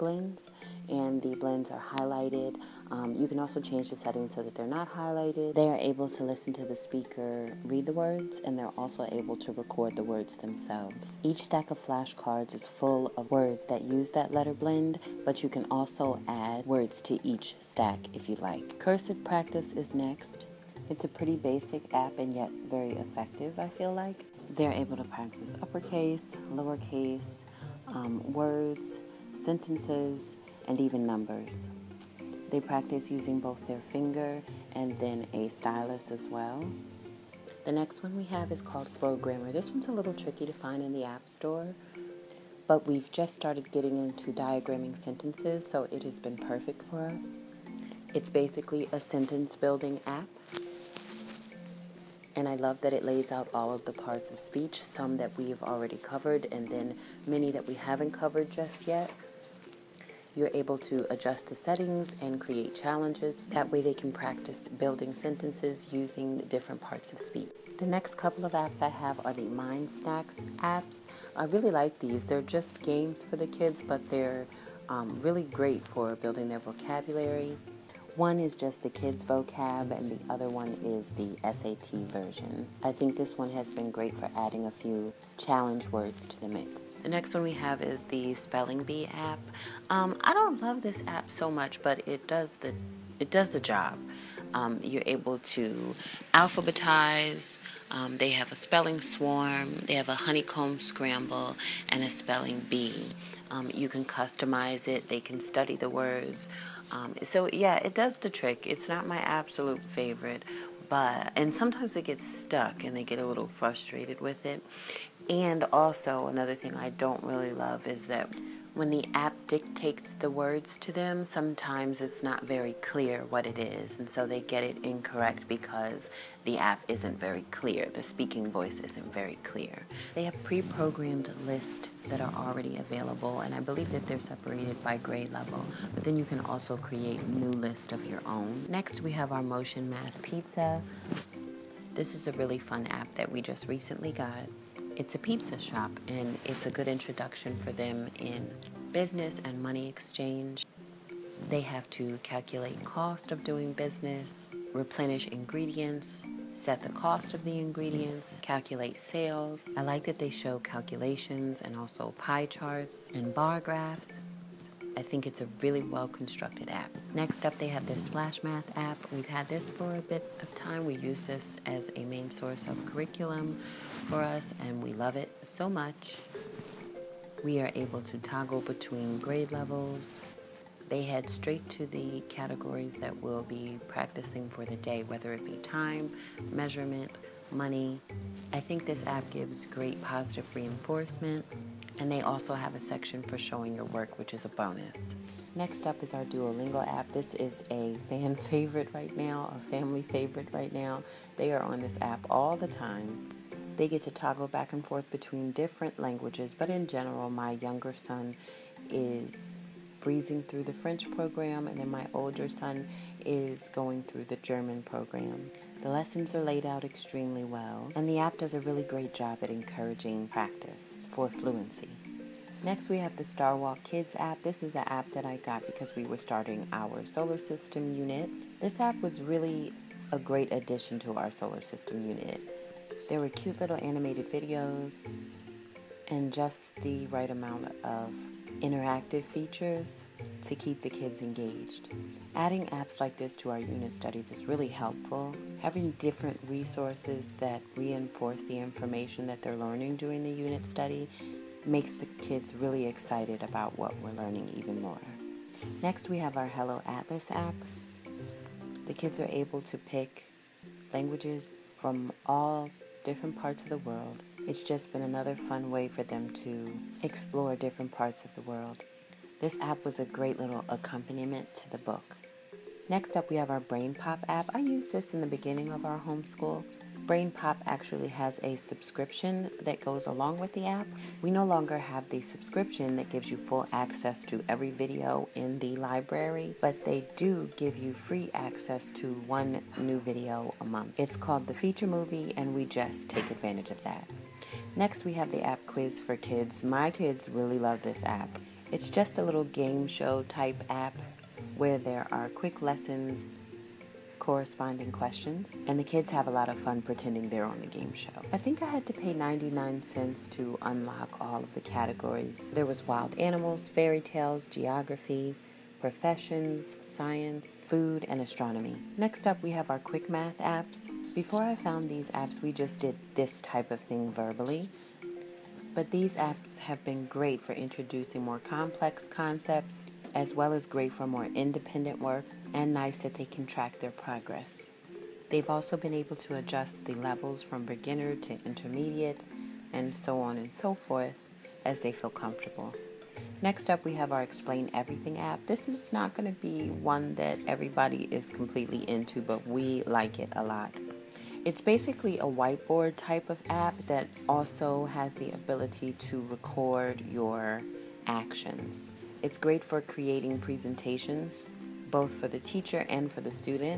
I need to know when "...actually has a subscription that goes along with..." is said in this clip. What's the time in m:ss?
4:37.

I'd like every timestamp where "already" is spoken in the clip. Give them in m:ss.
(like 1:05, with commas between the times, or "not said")
0:55, 2:12.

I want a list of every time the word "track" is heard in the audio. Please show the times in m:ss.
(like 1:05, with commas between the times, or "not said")
5:33.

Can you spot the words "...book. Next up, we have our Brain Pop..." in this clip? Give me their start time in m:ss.
4:31.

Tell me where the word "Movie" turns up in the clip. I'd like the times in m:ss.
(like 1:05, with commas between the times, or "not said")
4:51.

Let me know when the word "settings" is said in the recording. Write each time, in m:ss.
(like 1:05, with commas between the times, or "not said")
0:03, 1:01.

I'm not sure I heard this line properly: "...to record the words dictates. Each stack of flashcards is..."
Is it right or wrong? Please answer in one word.
wrong.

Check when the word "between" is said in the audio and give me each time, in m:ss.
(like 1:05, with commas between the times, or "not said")
2:58, 3:25.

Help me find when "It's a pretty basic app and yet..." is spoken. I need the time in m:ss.
0:20.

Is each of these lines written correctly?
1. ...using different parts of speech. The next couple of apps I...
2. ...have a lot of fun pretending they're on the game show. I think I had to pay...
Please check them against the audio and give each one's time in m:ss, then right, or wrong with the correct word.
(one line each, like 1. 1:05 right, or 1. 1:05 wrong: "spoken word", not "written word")
1. 1:05 right
2. 5:06 right.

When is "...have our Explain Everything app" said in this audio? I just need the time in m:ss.
5:43.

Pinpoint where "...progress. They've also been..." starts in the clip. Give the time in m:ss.
5:33.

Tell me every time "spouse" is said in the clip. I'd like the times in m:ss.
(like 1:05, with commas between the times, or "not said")
not said.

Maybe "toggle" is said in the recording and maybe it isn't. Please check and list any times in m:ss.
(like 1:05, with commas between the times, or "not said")
2:58, 3:24.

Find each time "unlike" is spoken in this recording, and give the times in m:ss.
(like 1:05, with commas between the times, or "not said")
not said.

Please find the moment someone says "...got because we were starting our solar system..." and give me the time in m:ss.
3:45.